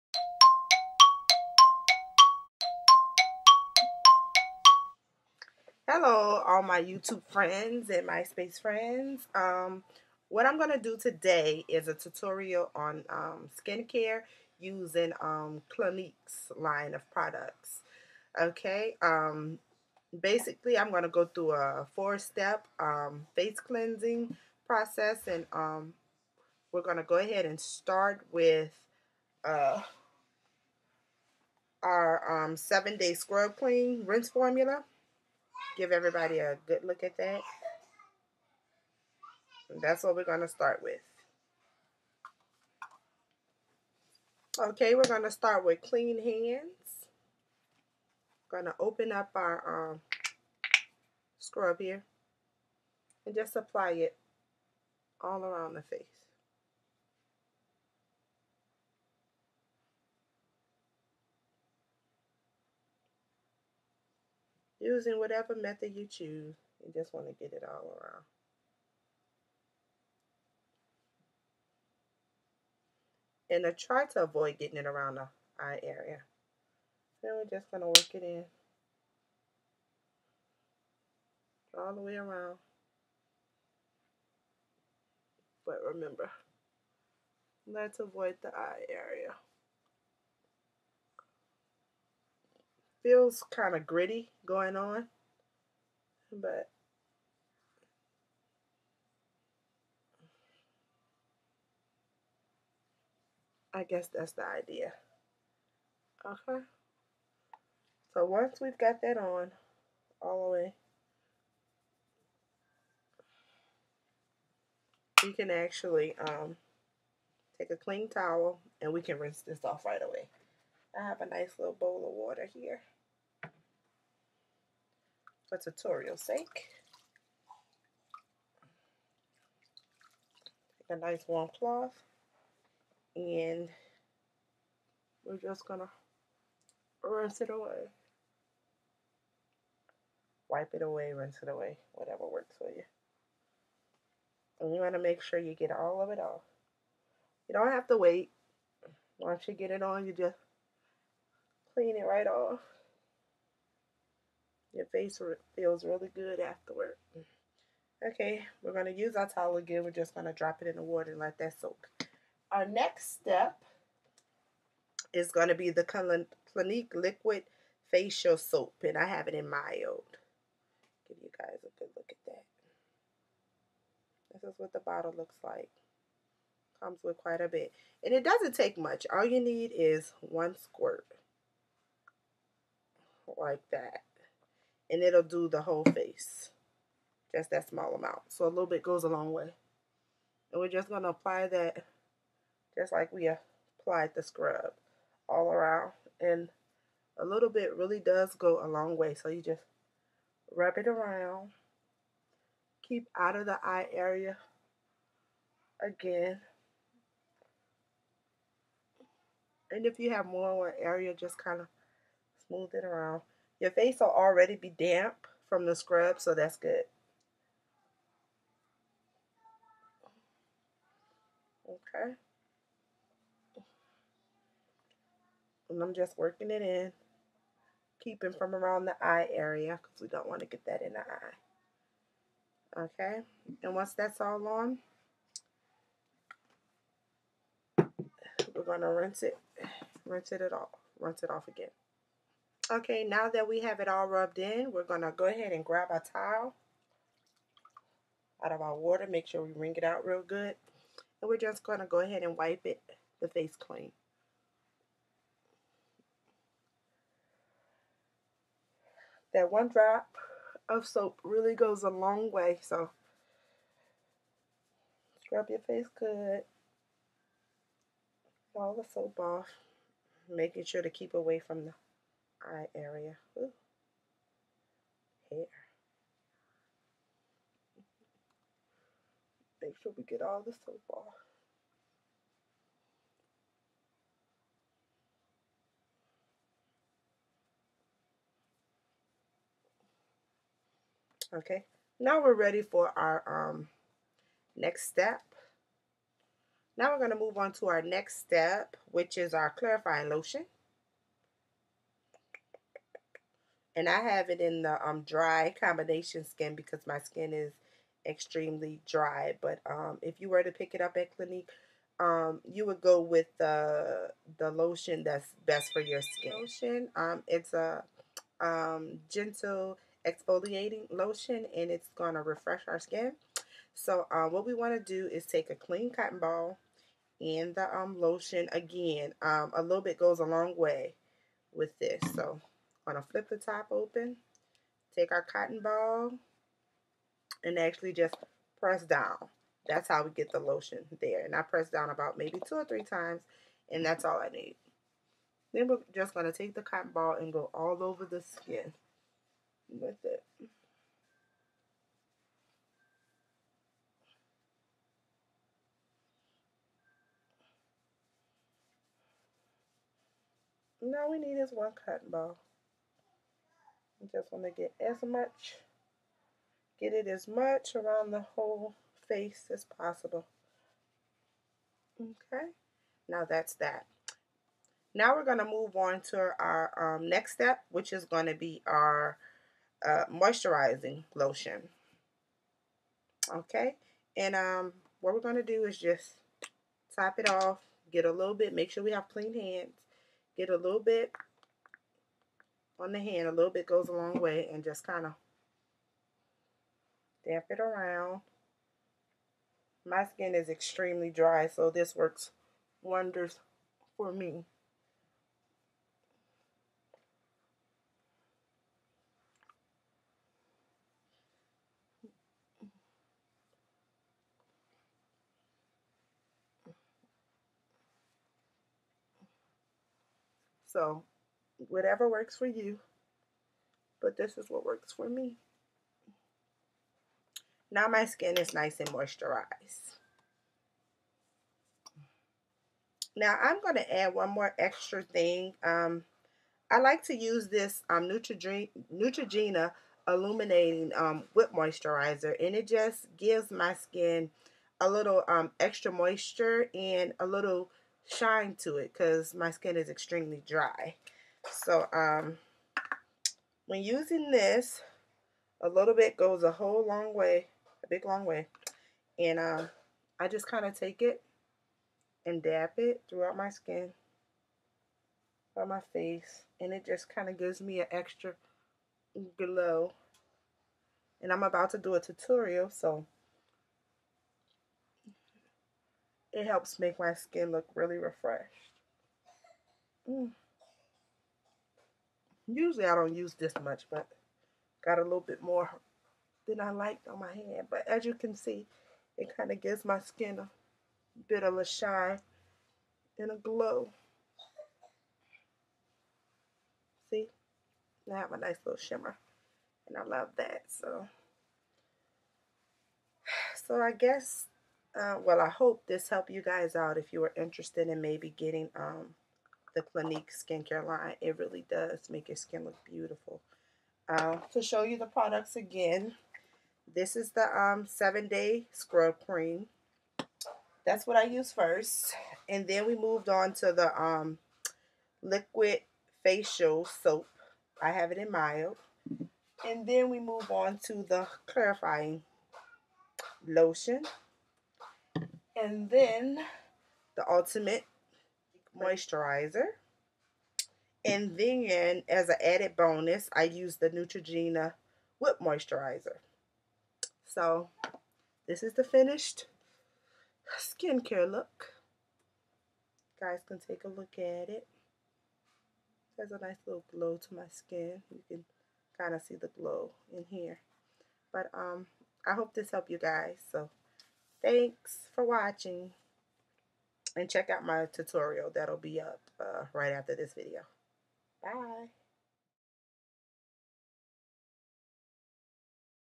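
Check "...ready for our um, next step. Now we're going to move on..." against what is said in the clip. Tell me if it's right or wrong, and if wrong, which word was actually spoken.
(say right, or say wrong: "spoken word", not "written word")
right.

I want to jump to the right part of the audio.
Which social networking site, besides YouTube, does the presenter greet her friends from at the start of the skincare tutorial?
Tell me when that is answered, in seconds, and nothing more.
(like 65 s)
8 s.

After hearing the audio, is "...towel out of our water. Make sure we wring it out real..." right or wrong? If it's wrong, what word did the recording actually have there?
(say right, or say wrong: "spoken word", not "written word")
right.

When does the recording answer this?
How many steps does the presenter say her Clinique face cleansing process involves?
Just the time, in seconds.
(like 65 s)
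21 s.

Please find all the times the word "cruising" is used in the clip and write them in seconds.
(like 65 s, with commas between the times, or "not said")
not said.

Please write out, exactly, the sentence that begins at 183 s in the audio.
Like that and it'll do the whole face.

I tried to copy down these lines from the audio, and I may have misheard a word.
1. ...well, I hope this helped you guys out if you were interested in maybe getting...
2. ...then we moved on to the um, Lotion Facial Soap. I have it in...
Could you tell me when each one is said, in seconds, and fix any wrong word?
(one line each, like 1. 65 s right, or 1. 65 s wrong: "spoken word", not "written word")
1. 505 s right
2. 522 s wrong: "Liquid", not "Lotion".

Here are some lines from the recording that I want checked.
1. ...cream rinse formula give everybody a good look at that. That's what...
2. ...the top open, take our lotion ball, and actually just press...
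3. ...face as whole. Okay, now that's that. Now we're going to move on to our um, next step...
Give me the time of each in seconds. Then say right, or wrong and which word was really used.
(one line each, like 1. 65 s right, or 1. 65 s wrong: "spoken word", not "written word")
1. 33 s right
2. 333 s wrong: "cotton", not "lotion"
3. 369 s wrong: "possible", not "whole".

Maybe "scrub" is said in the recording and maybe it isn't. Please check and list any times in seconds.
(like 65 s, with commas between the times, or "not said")
33 s, 51 s, 194 s, 215 s, 265 s, 518 s.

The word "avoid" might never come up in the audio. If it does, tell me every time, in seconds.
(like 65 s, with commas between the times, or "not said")
74 s, 87 s.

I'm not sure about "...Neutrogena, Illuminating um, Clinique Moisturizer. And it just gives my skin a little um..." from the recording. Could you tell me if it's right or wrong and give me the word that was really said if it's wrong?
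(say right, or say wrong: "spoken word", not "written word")
wrong: "Whip", not "Clinique".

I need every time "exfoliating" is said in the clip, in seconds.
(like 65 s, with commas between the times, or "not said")
320 s.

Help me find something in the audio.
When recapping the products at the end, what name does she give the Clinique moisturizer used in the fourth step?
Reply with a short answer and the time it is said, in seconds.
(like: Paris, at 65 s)
Ultimate moisturizer, at 537 s.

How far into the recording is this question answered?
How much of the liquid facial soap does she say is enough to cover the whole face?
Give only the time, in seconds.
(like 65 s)
180 s.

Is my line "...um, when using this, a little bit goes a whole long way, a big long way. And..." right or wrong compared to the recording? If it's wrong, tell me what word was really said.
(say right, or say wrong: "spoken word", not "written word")
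right.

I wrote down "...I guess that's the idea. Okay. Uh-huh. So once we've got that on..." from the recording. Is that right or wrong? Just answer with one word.
right.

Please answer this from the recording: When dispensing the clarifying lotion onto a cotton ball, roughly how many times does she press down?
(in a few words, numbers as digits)
2 or 3 times.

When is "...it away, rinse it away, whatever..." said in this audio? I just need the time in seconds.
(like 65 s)
140 s.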